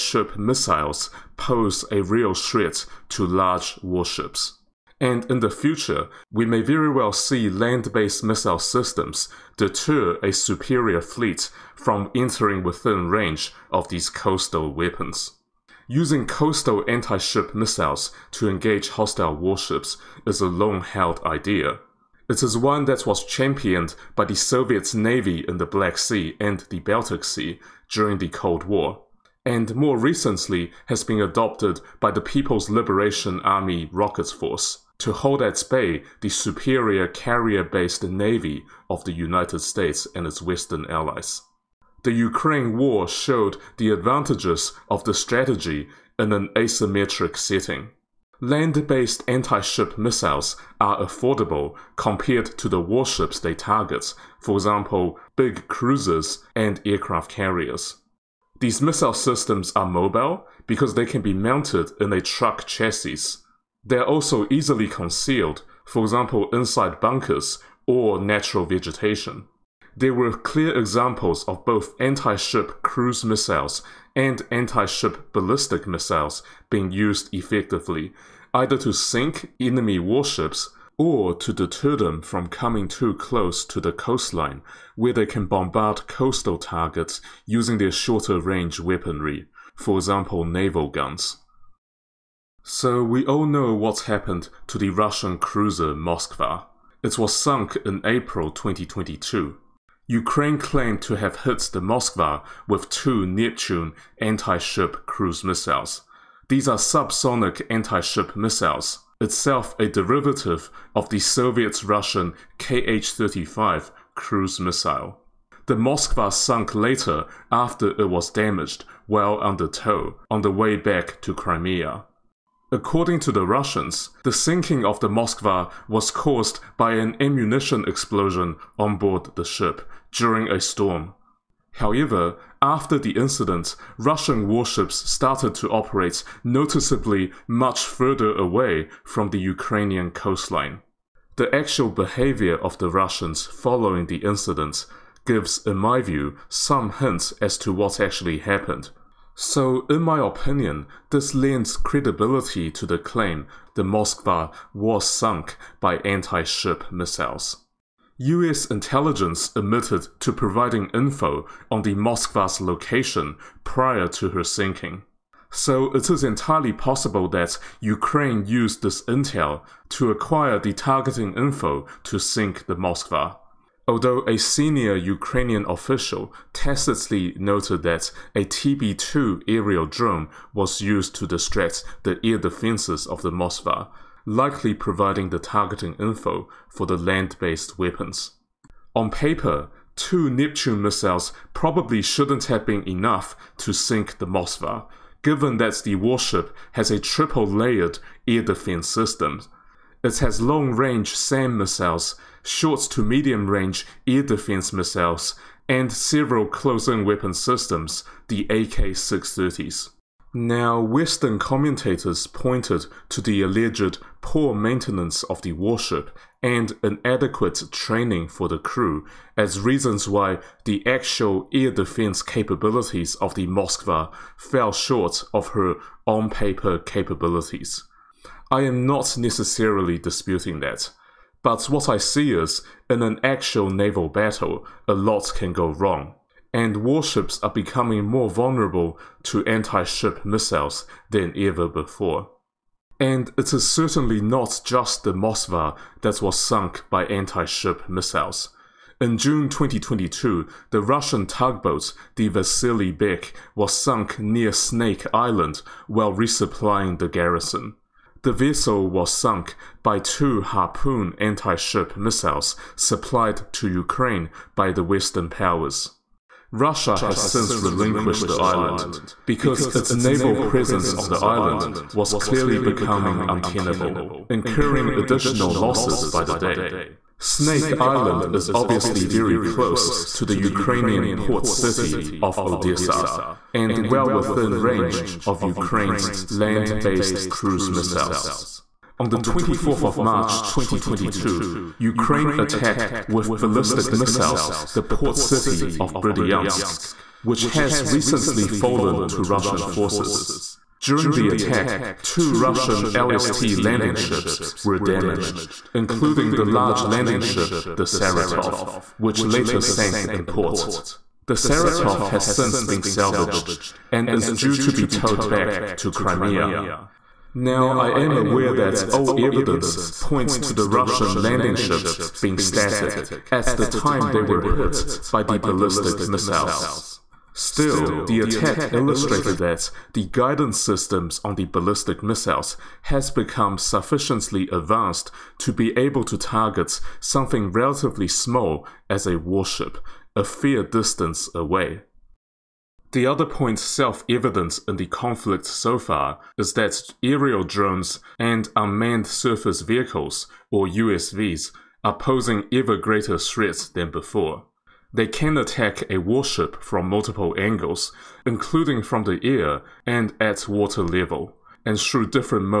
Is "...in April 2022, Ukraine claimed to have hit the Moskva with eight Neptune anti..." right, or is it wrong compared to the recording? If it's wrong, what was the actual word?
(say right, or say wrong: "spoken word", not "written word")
wrong: "two", not "eight".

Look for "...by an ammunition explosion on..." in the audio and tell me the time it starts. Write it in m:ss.
2:06.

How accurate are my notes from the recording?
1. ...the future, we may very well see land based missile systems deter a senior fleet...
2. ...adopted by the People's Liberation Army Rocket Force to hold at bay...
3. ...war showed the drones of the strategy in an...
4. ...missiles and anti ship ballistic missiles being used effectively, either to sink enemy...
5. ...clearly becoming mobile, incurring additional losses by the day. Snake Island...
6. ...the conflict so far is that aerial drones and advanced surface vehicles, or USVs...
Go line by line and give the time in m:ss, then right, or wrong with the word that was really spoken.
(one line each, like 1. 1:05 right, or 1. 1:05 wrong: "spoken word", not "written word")
1. 0:05 wrong: "superior", not "senior"
2. 0:31 right
3. 0:42 wrong: "advantages", not "drones"
4. 1:13 right
5. 4:32 wrong: "untenable", not "mobile"
6. 5:44 wrong: "unmanned", not "advanced".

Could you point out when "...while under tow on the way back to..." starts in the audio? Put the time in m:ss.
1:59.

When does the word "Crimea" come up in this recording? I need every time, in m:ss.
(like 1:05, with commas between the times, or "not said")
2:01, 5:15.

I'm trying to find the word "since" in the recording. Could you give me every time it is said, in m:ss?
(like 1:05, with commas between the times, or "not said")
4:27, 5:12.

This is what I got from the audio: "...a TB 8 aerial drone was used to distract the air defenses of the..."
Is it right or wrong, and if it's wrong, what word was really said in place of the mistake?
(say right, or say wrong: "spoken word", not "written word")
wrong: "2", not "8".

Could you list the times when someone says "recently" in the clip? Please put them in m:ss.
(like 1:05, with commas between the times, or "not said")
0:29, 4:57.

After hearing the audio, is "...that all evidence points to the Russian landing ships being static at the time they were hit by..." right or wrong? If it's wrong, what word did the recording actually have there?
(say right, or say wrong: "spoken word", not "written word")
right.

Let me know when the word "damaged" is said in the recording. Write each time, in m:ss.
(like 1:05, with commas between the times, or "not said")
1:58, 5:04.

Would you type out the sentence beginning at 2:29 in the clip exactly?
So, in my opinion, this lends credibility to the claim the Moskva was sunk by anti ship missiles.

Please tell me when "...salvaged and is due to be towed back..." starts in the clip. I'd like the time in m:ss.
5:12.